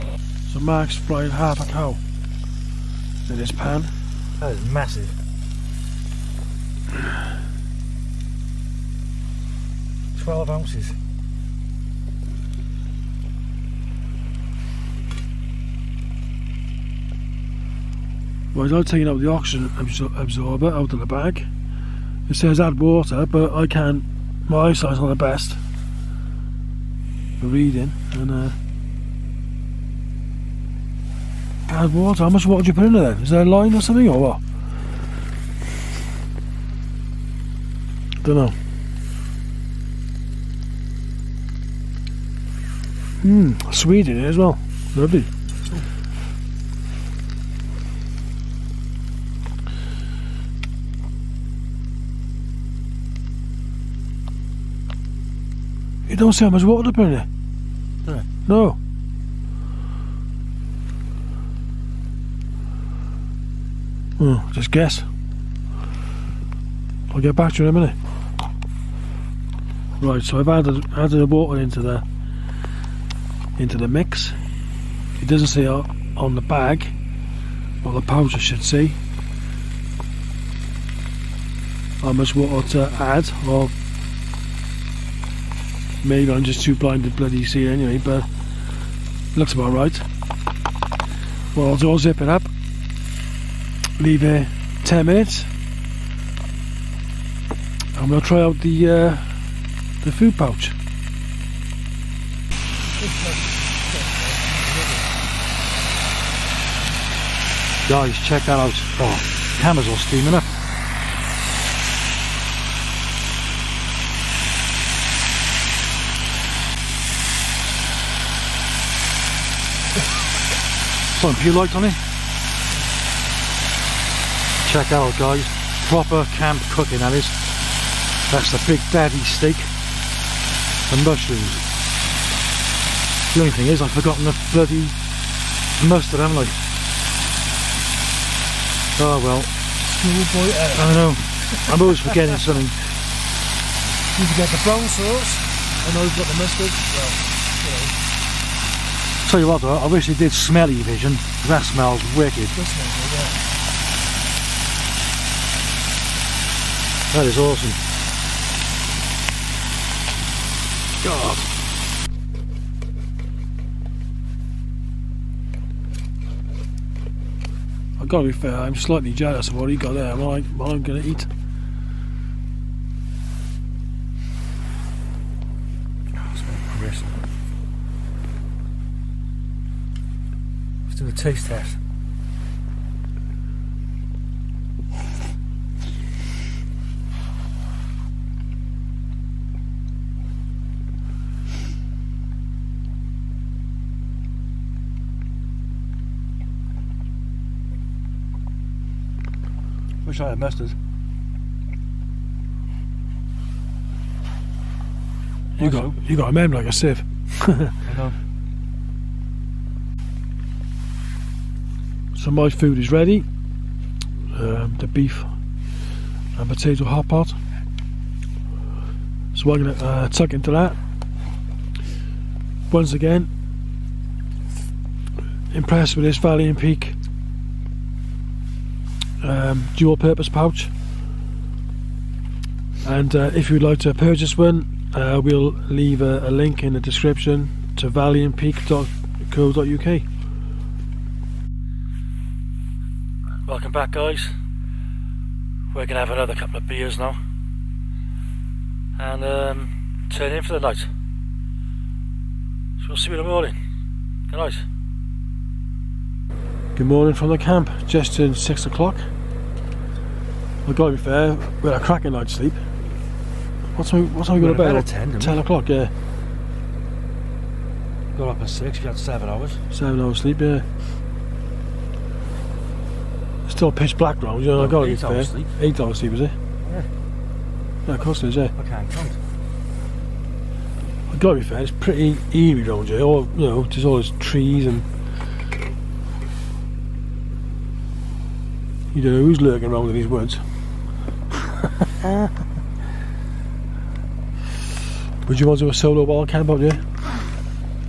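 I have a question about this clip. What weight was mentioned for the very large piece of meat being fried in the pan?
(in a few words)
12 ounces.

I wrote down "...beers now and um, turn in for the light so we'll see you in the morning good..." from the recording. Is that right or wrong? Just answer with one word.
wrong.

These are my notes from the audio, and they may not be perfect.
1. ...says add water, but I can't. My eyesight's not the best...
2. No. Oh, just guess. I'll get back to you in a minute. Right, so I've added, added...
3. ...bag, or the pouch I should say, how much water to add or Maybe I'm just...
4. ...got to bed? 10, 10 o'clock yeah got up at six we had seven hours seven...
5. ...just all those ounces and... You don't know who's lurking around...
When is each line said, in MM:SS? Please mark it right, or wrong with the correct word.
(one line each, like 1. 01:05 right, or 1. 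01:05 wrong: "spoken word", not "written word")
1. 00:22 right
2. 00:58 right
3. 01:16 right
4. 04:24 right
5. 04:43 wrong: "trees", not "ounces".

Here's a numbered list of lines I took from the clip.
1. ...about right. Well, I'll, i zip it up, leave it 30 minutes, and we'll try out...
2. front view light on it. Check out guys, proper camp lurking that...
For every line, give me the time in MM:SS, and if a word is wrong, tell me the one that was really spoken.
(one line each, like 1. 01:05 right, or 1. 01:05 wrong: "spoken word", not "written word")
1. 01:29 wrong: "10", not "30"
2. 02:01 wrong: "cooking", not "lurking".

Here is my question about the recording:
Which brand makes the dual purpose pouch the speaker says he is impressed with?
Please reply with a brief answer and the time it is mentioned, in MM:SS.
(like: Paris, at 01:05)
Valley and Peak, at 03:46.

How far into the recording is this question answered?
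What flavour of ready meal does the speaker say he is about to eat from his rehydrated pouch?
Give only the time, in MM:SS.
03:34.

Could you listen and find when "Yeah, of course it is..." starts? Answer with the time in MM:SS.
04:37.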